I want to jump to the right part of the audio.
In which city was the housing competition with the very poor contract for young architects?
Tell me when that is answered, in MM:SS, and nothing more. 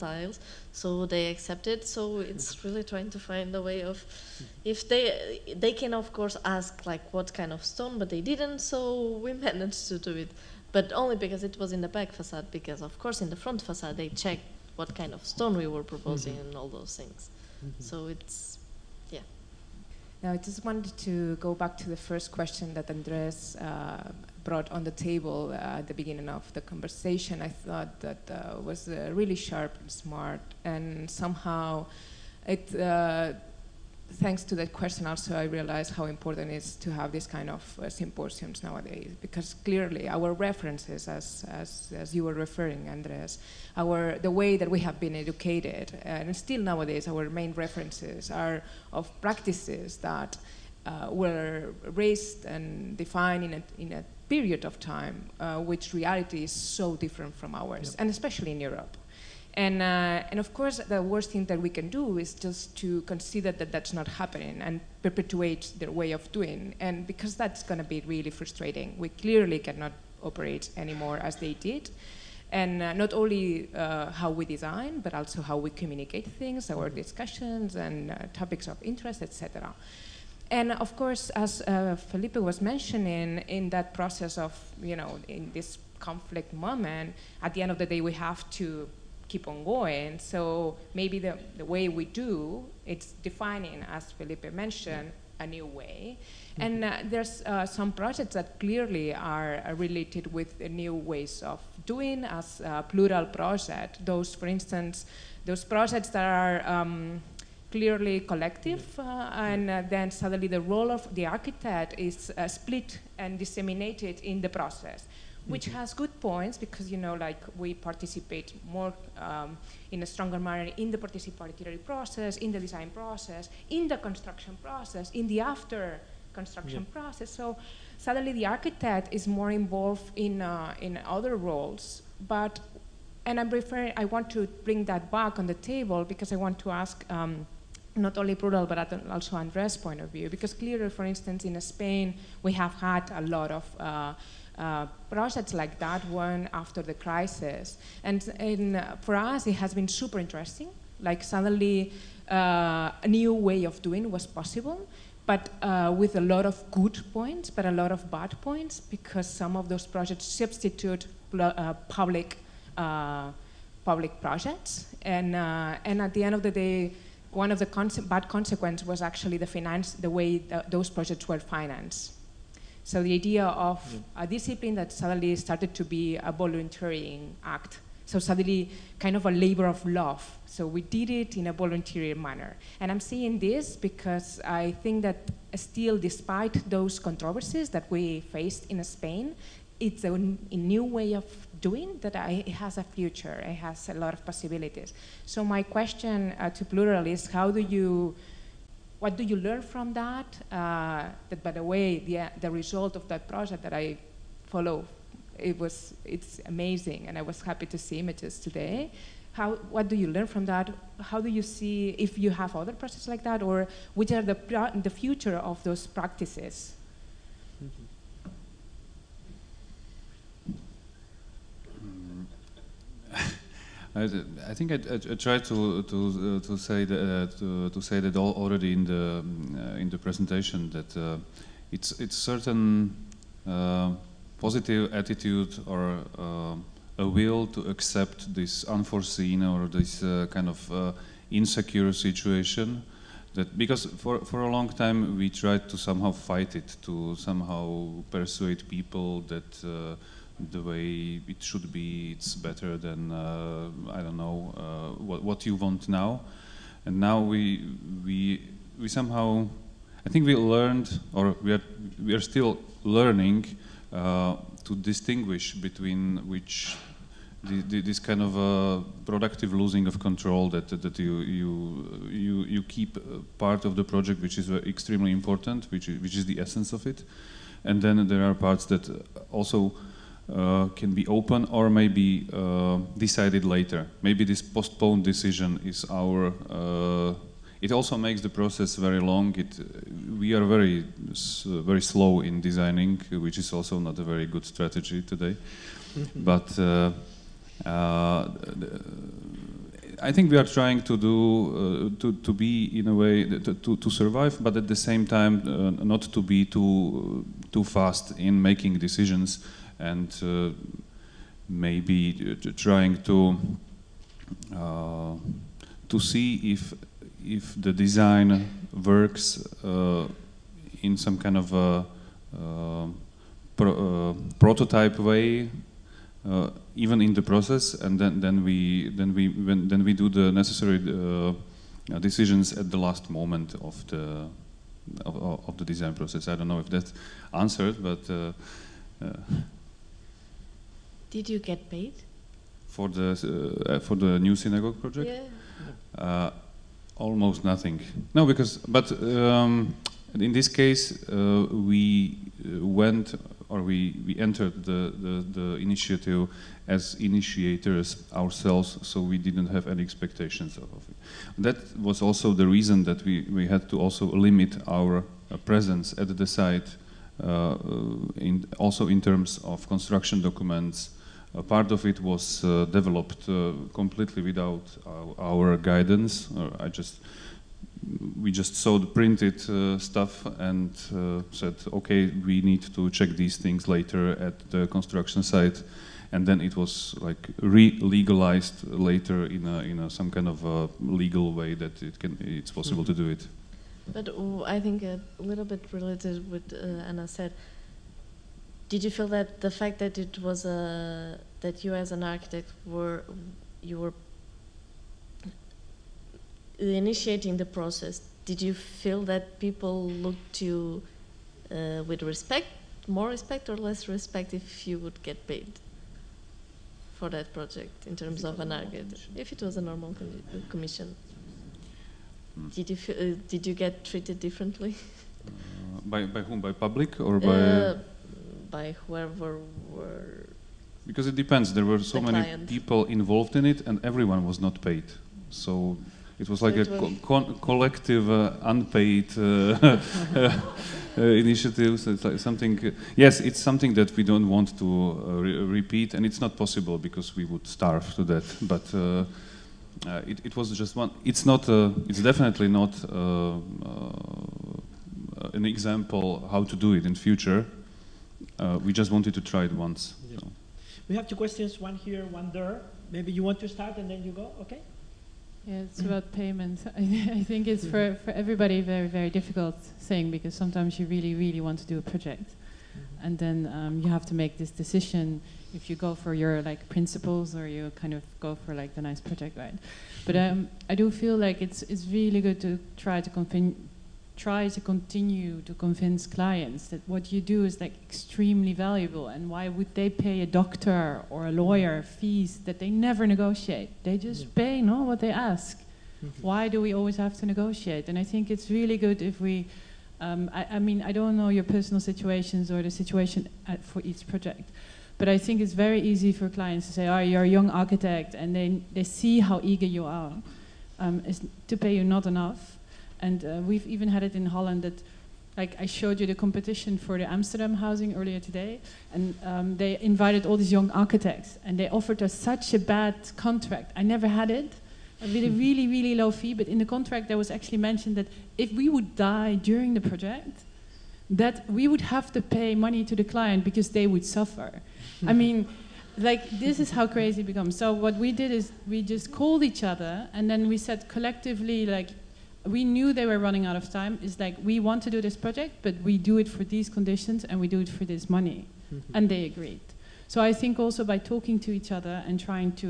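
08:37.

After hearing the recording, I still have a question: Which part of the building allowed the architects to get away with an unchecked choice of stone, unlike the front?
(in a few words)
back facade.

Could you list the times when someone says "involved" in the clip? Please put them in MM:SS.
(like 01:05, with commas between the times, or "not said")
02:09, 07:12.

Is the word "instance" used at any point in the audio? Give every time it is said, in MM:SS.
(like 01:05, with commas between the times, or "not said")
01:44, 02:21.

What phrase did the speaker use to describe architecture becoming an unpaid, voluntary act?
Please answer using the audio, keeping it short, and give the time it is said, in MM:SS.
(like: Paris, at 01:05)
labor of love, at 02:59.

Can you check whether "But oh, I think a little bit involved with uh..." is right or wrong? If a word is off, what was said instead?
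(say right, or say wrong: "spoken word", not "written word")
wrong: "related", not "involved".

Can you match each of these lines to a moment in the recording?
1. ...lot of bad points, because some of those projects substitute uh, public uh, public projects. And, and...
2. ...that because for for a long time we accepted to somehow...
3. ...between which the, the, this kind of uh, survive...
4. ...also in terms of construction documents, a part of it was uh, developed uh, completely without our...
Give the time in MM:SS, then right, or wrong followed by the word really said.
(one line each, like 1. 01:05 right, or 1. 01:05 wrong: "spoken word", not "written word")
1. 02:37 right
2. 04:03 wrong: "tried", not "accepted"
3. 04:25 wrong: "productive", not "survive"
4. 06:08 right.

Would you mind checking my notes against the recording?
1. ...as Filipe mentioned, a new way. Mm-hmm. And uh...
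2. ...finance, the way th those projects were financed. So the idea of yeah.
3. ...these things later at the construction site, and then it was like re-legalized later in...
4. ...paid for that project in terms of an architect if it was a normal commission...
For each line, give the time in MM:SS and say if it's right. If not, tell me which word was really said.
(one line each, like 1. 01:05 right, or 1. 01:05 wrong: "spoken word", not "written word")
1. 01:33 right
2. 02:49 right
3. 06:23 right
4. 06:55 right.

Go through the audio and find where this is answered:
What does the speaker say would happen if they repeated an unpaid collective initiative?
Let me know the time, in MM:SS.
07:27.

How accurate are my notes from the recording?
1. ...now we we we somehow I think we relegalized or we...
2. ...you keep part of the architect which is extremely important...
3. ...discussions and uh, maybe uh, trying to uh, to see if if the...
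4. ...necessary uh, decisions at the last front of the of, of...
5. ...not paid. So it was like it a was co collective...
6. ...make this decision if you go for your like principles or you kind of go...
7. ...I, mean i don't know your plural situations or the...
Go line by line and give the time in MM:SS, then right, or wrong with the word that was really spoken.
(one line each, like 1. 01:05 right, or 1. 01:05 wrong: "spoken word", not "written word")
1. 04:16 wrong: "learned", not "relegalized"
2. 04:32 wrong: "project", not "architect"
3. 05:08 wrong: "decisions", not "discussions"
4. 05:30 wrong: "moment", not "front"
5. 07:14 right
6. 07:54 right
7. 08:20 wrong: "personal", not "plural".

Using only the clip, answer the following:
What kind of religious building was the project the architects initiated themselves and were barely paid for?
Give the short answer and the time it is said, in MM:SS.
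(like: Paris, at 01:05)
synagogue, at 05:44.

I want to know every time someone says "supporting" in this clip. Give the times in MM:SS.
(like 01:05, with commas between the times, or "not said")
not said.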